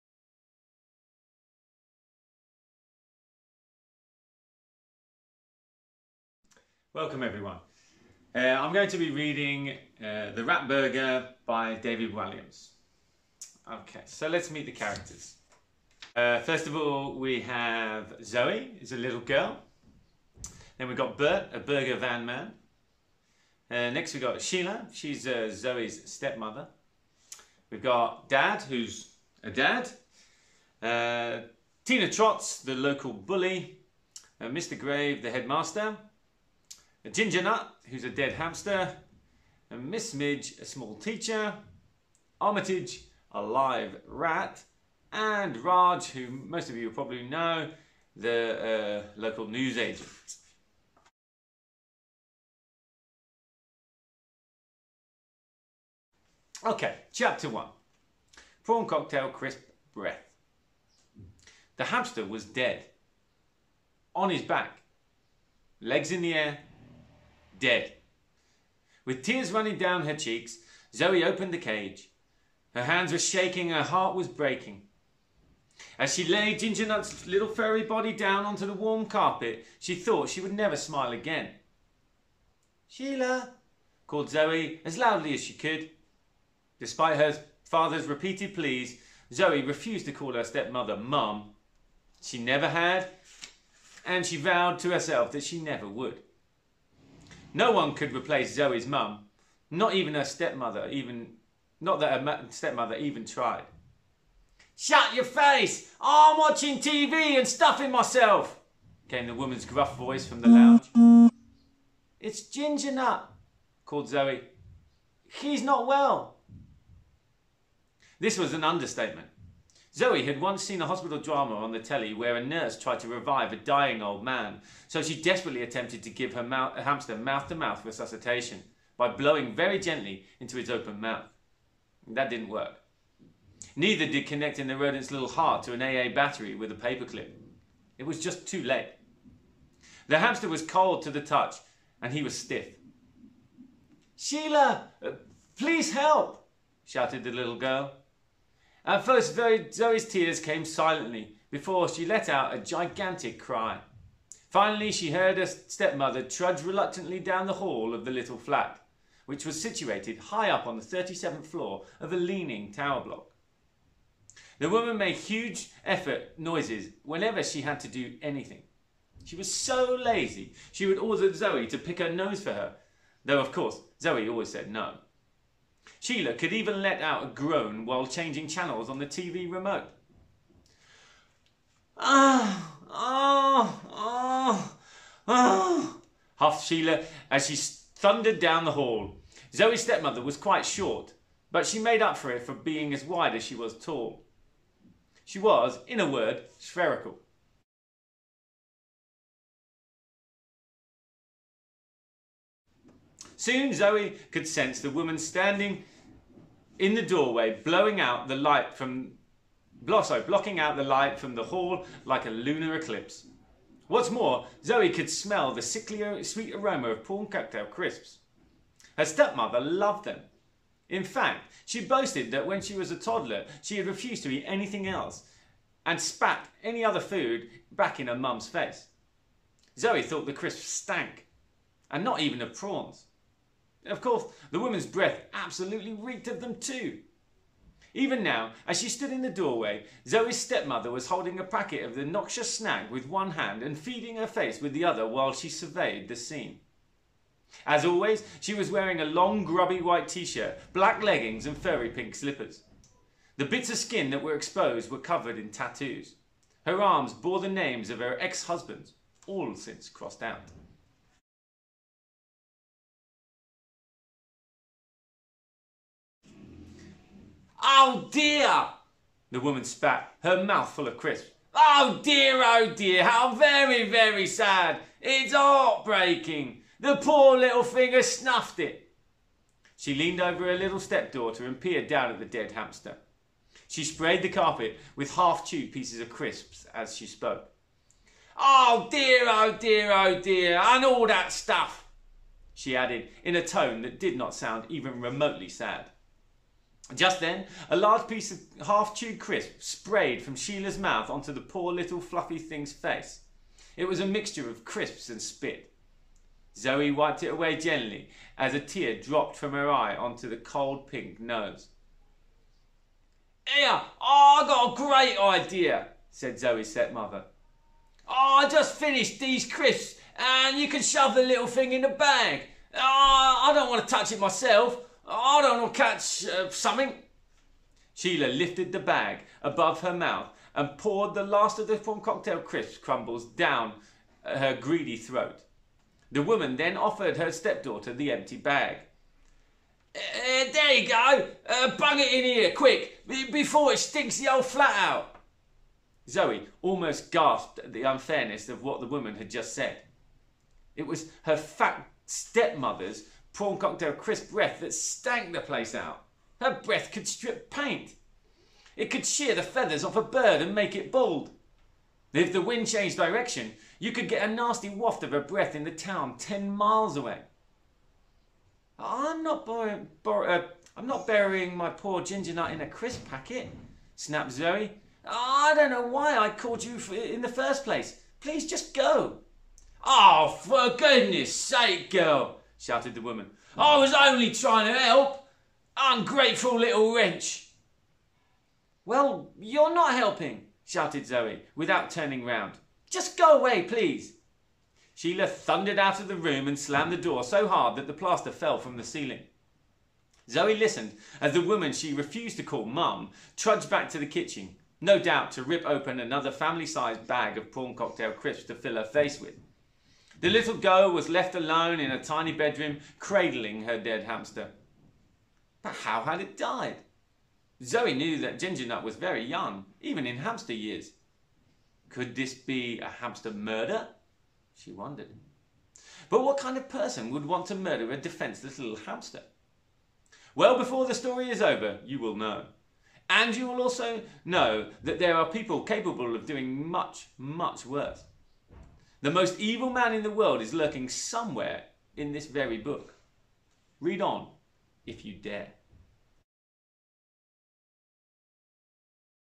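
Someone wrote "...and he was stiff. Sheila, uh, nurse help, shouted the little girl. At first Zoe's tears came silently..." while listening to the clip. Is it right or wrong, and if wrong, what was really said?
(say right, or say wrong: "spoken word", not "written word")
wrong: "please", not "nurse".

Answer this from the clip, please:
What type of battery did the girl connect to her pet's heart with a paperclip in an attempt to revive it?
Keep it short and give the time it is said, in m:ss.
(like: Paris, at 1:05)
AA battery, at 2:15.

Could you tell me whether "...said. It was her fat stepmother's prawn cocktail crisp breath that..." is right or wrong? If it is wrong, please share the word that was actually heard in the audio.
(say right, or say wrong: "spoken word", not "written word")
right.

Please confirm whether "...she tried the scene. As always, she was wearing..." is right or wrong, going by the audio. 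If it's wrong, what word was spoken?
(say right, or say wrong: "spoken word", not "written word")
wrong: "surveyed", not "tried".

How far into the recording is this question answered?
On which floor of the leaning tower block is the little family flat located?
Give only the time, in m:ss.
2:40.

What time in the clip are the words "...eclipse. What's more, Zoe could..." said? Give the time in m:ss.
3:32.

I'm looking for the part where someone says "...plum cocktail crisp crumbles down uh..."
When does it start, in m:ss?
5:31.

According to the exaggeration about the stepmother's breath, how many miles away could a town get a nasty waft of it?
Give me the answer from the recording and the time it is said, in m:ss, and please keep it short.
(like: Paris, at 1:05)
10 miles, at 6:06.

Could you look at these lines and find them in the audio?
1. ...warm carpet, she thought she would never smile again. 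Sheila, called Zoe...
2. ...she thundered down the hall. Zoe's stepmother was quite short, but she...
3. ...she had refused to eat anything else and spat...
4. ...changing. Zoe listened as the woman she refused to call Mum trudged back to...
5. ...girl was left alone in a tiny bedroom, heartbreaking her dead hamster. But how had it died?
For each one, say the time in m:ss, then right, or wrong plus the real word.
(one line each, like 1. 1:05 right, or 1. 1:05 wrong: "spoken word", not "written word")
1. 1:18 right
2. 3:07 right
3. 3:43 right
4. 6:38 wrong: "ceiling", not "changing"
5. 6:50 wrong: "cradling", not "heartbreaking".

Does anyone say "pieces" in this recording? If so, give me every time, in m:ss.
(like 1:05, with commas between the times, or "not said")
4:45, 4:58.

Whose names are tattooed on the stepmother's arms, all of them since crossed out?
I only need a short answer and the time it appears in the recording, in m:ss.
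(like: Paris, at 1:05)
Her ex husbands, at 4:18.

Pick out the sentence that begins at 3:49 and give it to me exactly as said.
Zoe thought the crisps stank, and not even of prawns of course, the woman's breath absolutely reeked of them too.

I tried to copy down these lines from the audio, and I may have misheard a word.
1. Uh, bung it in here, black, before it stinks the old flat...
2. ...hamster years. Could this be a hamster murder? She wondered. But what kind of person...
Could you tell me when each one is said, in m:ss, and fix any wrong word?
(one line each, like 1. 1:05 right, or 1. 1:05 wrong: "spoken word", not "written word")
1. 5:41 wrong: "quick", not "black"
2. 7:00 right.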